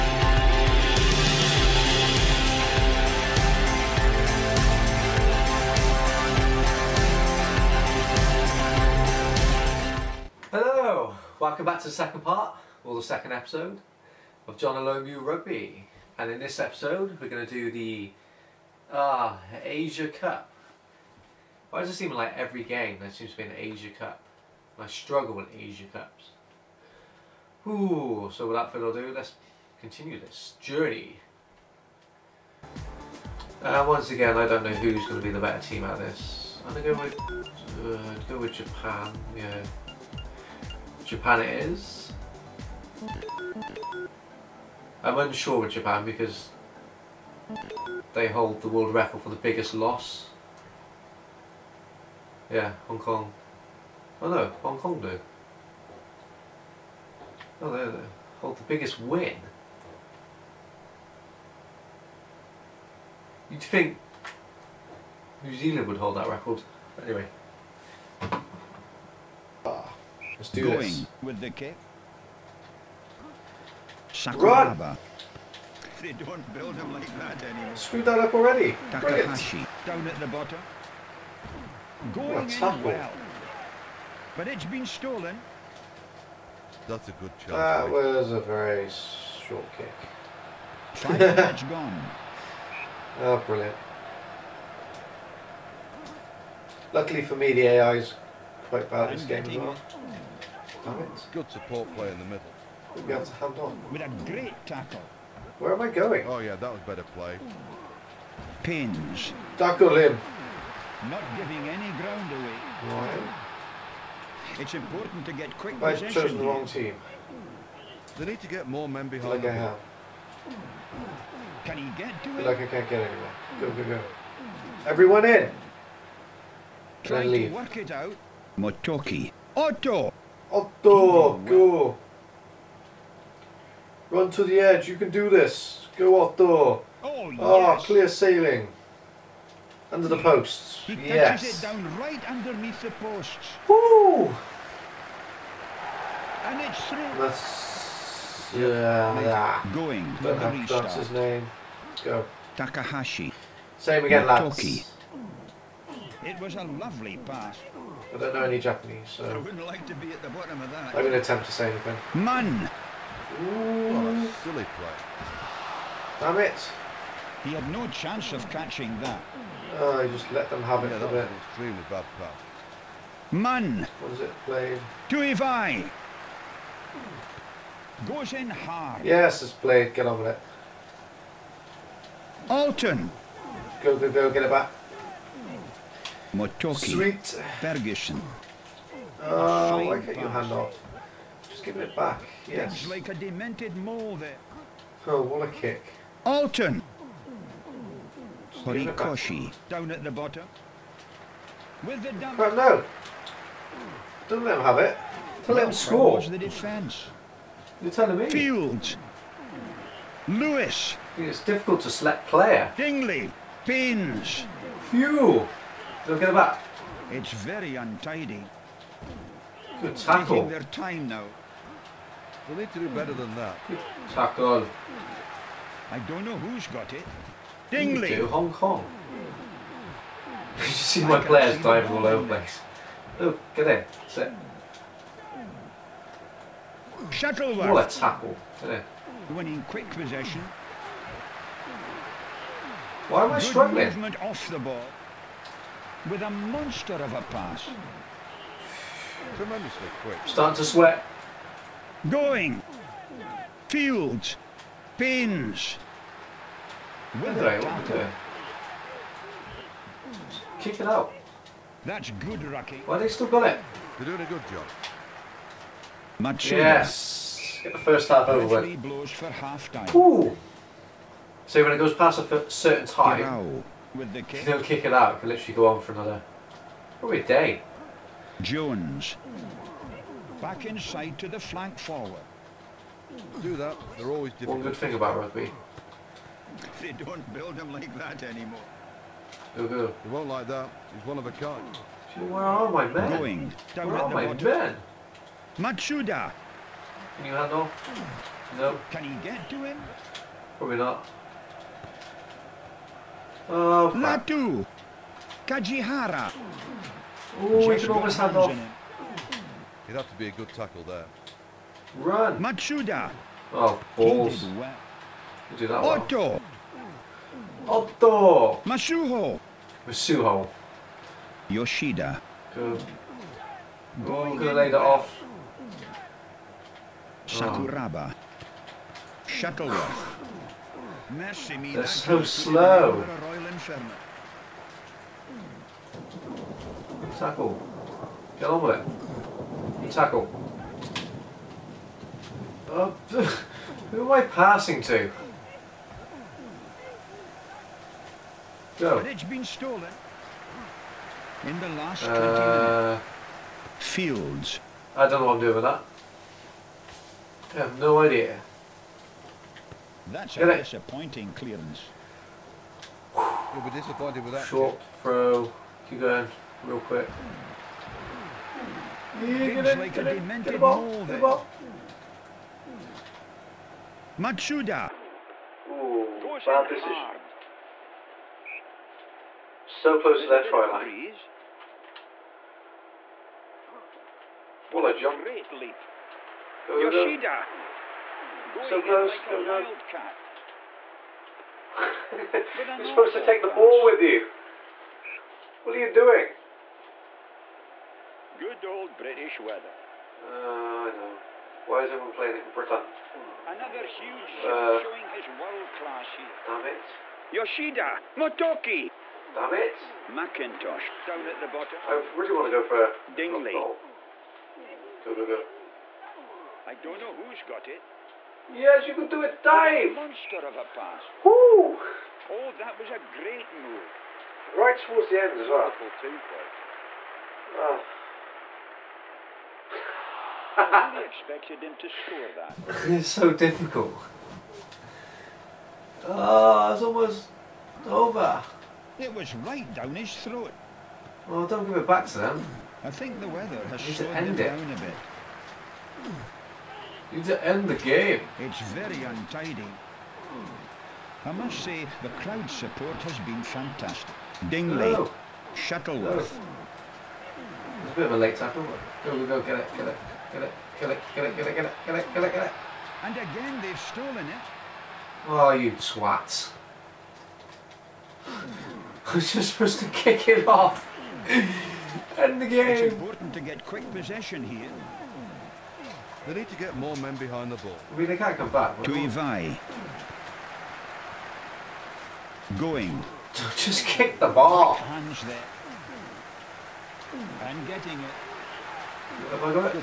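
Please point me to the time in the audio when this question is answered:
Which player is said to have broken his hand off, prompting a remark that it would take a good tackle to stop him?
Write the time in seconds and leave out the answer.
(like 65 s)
305 s.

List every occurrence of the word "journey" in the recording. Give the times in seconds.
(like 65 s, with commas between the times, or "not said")
30 s.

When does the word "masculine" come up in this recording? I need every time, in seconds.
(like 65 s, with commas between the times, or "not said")
not said.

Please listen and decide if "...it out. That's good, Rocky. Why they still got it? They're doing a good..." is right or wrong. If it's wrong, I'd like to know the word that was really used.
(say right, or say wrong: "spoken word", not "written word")
right.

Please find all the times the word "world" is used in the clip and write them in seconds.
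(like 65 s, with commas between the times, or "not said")
48 s, 405 s.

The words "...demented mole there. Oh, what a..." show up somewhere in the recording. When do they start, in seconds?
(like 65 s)
193 s.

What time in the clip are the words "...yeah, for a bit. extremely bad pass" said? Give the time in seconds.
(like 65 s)
170 s.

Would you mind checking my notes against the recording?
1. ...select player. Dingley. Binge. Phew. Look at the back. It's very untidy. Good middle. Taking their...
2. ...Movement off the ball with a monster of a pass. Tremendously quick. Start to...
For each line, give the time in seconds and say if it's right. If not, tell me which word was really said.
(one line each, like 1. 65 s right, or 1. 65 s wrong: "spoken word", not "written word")
1. 211 s wrong: "tackle", not "middle"
2. 243 s right.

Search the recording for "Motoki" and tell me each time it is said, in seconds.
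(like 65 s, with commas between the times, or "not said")
128 s, 154 s, 186 s, 408 s.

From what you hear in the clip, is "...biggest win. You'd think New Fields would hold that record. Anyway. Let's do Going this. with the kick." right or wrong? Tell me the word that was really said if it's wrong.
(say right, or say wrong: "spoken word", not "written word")
wrong: "Zealand", not "Fields".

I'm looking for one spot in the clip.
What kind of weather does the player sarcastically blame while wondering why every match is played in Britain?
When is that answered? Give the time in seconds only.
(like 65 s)
398 s.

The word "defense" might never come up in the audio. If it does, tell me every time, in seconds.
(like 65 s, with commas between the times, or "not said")
206 s.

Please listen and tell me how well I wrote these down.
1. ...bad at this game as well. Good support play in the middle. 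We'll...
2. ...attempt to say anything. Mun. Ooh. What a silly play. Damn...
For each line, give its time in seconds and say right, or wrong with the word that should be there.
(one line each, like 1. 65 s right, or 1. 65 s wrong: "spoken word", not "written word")
1. 98 s right
2. 161 s right.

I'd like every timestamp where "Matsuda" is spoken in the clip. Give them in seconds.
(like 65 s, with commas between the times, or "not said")
295 s, 312 s, 374 s.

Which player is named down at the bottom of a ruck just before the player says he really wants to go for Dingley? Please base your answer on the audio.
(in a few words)
Macintosh.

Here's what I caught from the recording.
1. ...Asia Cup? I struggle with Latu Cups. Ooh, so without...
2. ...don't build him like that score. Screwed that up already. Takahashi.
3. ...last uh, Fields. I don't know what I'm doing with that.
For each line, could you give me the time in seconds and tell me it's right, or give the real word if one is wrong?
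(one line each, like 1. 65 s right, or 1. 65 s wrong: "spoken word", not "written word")
1. 23 s wrong: "Asia", not "Latu"
2. 76 s wrong: "anymore", not "score"
3. 351 s right.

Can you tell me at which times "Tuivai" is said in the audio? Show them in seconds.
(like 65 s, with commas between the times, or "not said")
175 s, 478 s.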